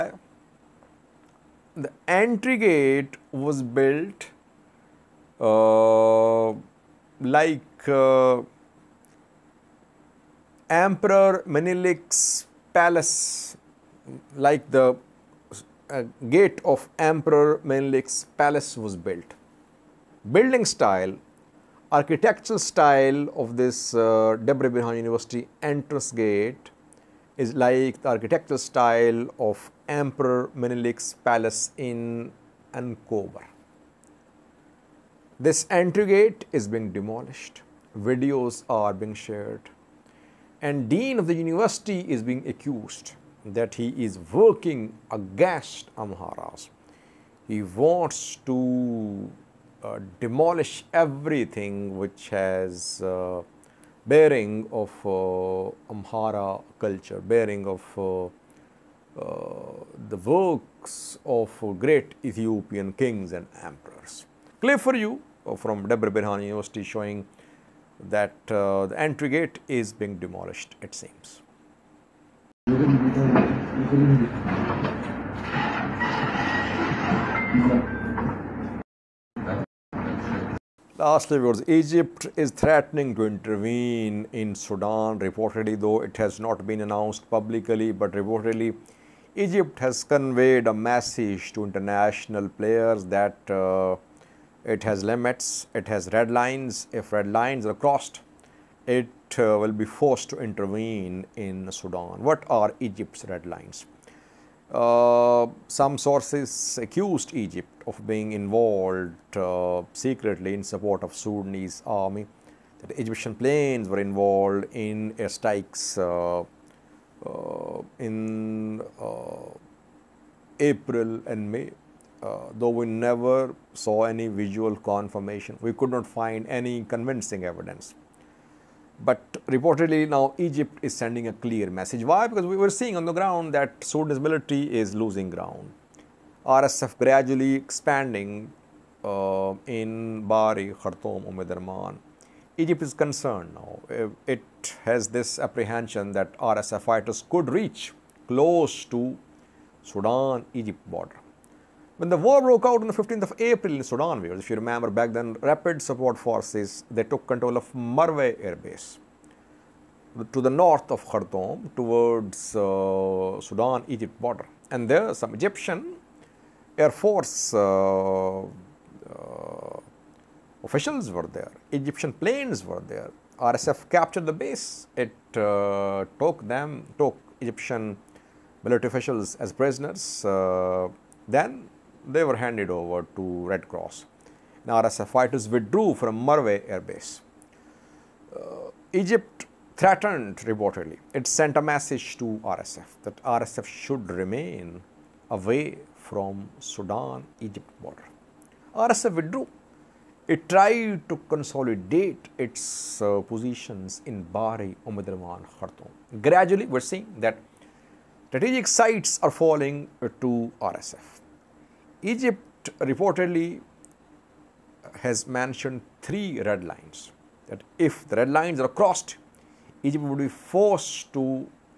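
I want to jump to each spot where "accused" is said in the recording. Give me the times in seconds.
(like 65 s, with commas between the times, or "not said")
42 s, 106 s.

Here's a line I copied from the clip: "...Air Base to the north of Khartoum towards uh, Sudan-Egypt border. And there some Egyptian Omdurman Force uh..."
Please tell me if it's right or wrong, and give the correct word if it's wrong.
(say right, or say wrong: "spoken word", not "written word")
wrong: "Air", not "Omdurman".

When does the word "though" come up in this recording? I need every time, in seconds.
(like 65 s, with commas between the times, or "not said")
85 s, 122 s.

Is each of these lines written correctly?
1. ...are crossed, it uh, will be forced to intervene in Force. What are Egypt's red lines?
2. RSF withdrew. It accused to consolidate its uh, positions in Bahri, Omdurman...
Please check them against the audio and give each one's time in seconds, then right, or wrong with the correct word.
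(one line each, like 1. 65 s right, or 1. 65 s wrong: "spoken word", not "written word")
1. 97 s wrong: "Sudan", not "Force"
2. 198 s wrong: "tried", not "accused".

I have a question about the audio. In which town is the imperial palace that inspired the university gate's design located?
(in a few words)
Ankober.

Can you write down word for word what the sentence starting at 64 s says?
Clear for you from Debre Berhan University showing that the entry gate is being demolished, it seems.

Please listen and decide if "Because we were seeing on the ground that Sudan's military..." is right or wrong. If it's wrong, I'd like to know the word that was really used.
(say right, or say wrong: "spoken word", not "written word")
right.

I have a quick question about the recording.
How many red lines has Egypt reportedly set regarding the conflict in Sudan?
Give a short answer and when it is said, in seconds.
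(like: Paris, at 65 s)
3, at 216 s.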